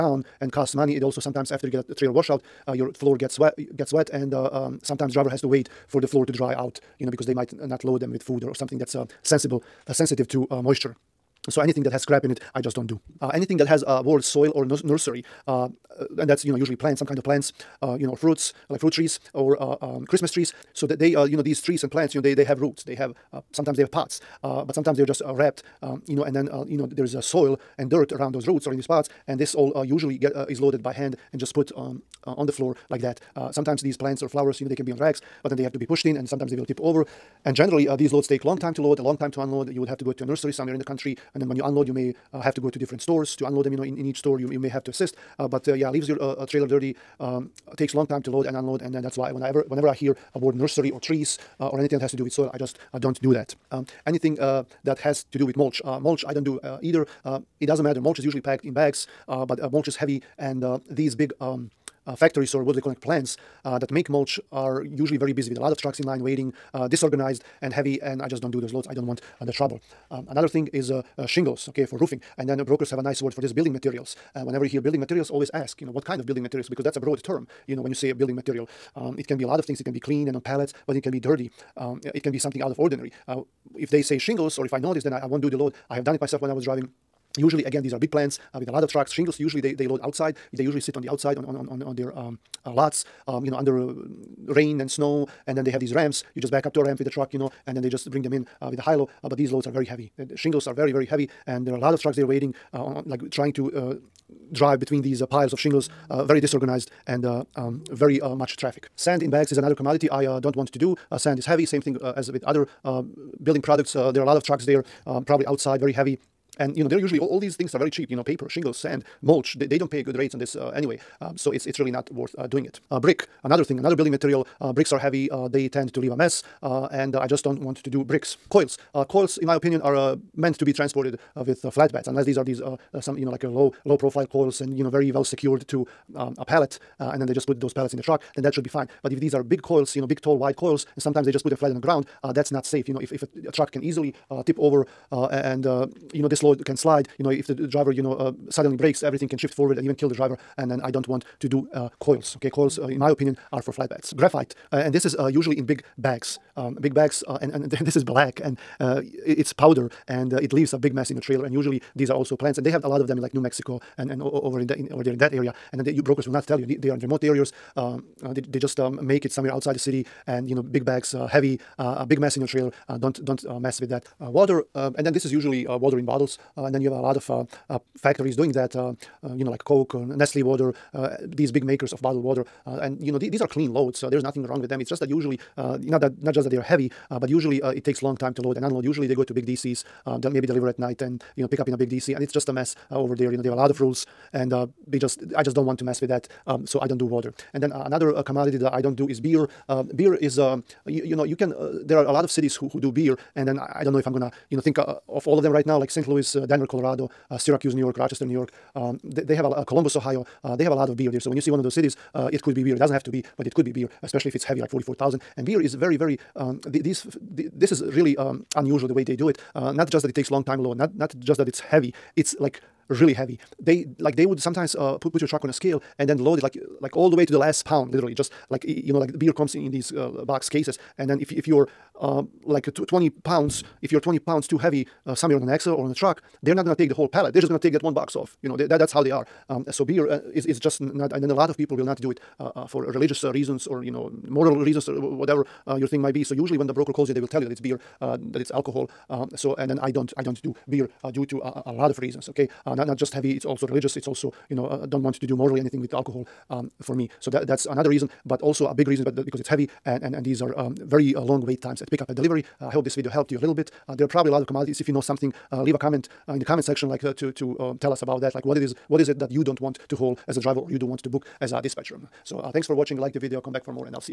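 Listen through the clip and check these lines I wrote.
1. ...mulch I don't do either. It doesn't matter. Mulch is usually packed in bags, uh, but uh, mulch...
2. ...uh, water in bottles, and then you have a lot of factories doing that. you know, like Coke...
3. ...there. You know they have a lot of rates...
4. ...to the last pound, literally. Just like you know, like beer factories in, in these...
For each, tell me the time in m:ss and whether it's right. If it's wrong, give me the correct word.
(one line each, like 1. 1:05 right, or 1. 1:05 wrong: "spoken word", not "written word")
1. 0:55 right
2. 2:55 right
3. 3:13 wrong: "rules", not "rates"
4. 3:47 wrong: "comes", not "factories".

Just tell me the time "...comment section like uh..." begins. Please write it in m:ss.
4:26.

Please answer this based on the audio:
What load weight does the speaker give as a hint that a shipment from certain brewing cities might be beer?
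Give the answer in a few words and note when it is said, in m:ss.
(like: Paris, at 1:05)
44,000, at 3:34.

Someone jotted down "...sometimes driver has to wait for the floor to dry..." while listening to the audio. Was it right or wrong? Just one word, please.
right.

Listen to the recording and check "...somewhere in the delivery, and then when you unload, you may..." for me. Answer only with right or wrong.
wrong.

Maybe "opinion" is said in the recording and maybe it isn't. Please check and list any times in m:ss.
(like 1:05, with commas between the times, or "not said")
2:09, 2:33.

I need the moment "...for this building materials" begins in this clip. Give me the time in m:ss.
1:13.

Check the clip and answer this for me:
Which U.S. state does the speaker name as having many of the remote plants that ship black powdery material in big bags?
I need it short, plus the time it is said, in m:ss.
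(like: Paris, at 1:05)
New Mexico, at 2:43.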